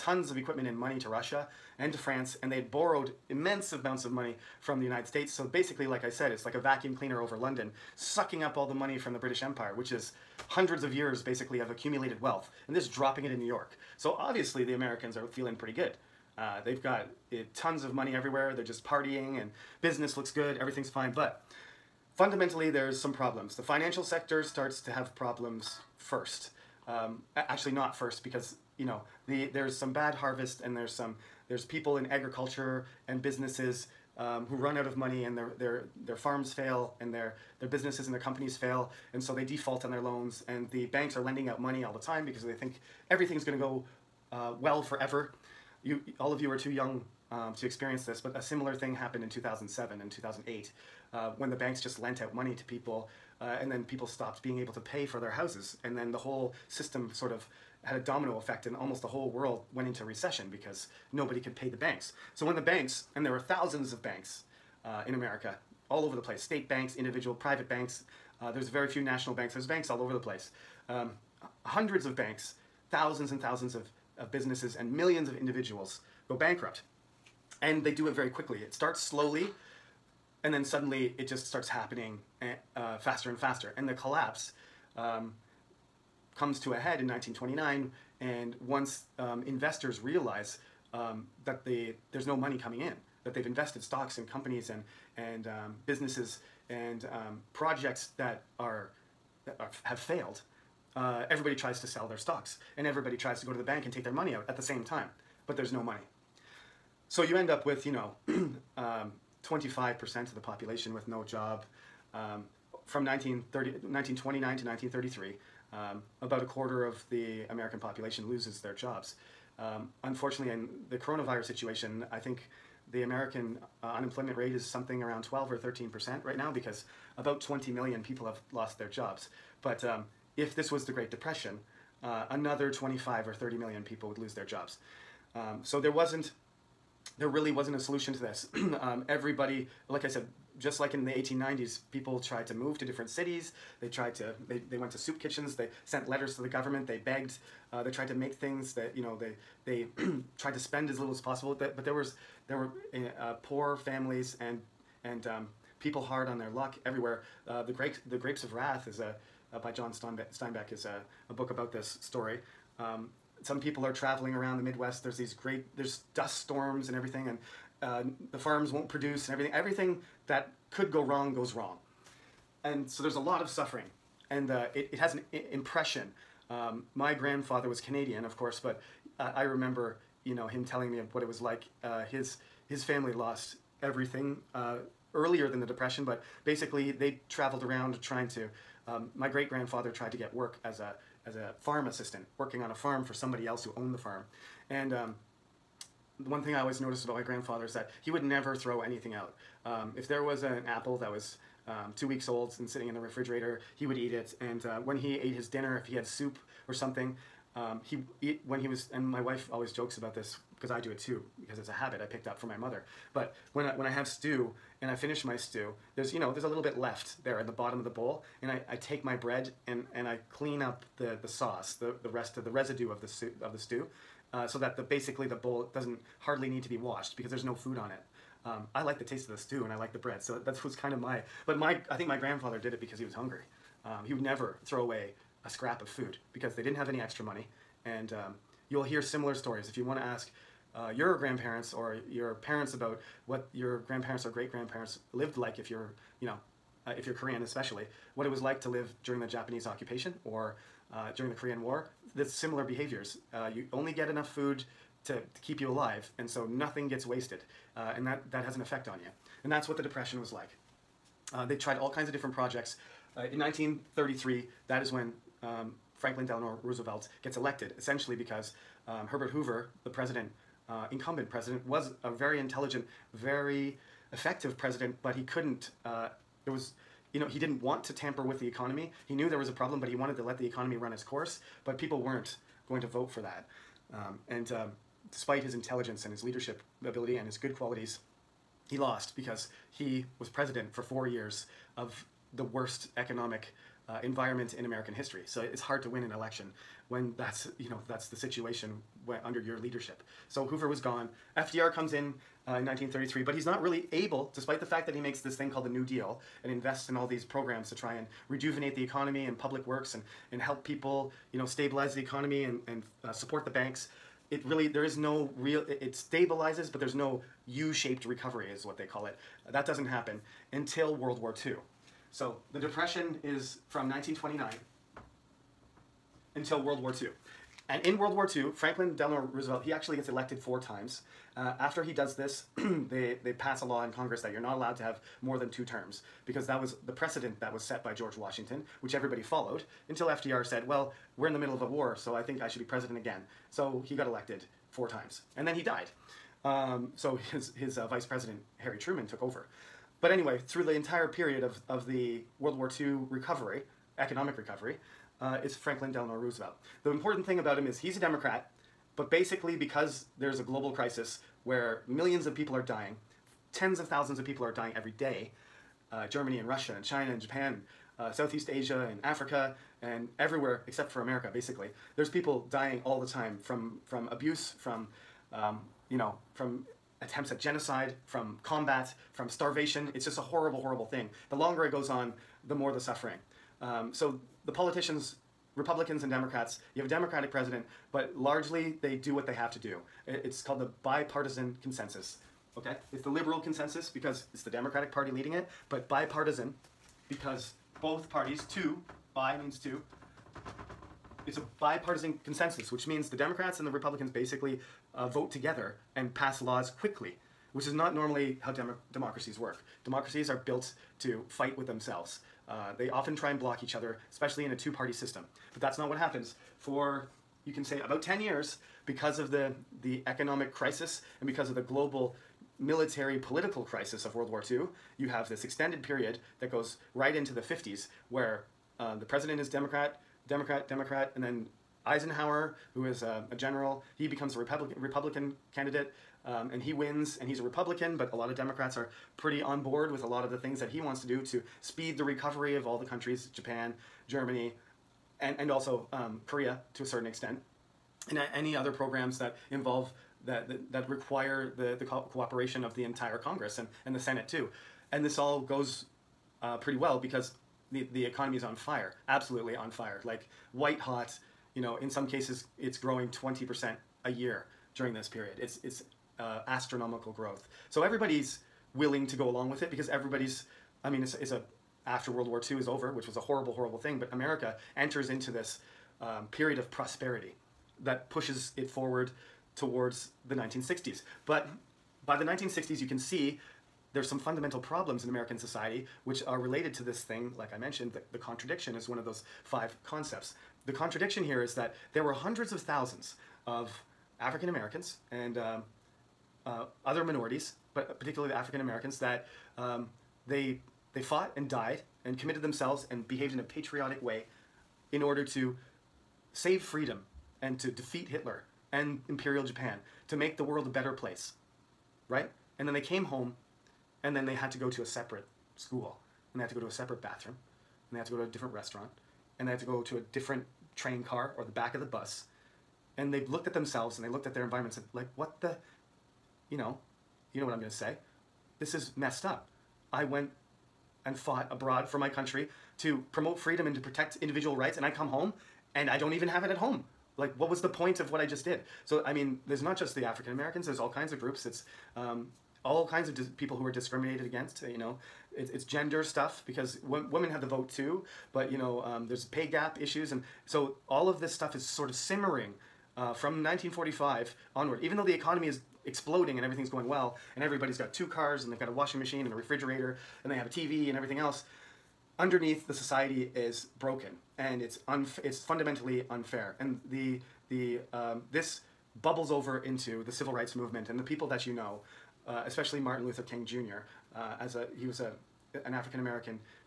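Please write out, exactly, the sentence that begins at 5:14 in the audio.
It really, there is no real, it, it stabilizes, but there's no U-shaped recovery is what they call it.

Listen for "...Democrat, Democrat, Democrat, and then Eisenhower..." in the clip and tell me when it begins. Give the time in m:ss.
7:09.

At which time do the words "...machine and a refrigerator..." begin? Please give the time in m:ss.
9:18.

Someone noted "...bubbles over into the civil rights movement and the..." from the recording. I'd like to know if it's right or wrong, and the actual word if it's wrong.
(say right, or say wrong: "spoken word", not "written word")
right.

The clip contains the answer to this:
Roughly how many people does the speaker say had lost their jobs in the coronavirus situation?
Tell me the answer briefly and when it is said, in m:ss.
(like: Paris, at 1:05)
20 million, at 2:07.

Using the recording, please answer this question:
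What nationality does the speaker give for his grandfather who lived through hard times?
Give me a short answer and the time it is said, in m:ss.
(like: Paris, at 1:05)
Canadian, at 2:57.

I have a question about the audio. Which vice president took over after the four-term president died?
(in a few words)
Harry Truman.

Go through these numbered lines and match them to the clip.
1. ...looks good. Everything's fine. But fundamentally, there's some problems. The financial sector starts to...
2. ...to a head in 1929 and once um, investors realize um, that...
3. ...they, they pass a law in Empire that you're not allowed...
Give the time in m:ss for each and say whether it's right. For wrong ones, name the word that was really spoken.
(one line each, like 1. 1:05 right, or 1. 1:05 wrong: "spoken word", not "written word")
1. 0:20 right
2. 1:26 right
3. 5:32 wrong: "Congress", not "Empire".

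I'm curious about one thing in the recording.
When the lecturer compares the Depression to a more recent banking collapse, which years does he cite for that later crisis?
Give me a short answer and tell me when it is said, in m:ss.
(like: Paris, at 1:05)
2007 and 2008, at 0:49.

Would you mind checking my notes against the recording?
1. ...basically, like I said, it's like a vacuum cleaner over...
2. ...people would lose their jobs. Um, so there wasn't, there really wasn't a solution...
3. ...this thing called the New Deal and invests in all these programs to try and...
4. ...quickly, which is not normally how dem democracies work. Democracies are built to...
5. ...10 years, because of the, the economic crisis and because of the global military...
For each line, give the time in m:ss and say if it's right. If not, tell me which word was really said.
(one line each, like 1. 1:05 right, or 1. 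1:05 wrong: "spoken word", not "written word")
1. 0:05 right
2. 2:13 right
3. 5:05 right
4. 6:46 right
5. 6:58 right.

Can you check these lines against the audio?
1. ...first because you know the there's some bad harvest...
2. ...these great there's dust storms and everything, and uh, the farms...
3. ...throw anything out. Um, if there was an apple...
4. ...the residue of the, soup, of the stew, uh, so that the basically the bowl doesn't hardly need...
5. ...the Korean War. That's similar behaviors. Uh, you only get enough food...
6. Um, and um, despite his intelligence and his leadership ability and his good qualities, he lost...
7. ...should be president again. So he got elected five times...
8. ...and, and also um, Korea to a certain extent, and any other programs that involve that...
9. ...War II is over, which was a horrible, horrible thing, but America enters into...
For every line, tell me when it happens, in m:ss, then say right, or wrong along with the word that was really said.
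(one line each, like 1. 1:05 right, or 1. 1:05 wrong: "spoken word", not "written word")
1. 0:27 right
2. 2:45 right
3. 3:18 right
4. 3:42 right
5. 4:11 right
6. 4:43 right
7. 5:42 wrong: "four", not "five"
8. 7:25 right
9. 7:52 right.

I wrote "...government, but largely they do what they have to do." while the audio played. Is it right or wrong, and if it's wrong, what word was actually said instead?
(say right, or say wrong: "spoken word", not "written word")
wrong: "president", not "government".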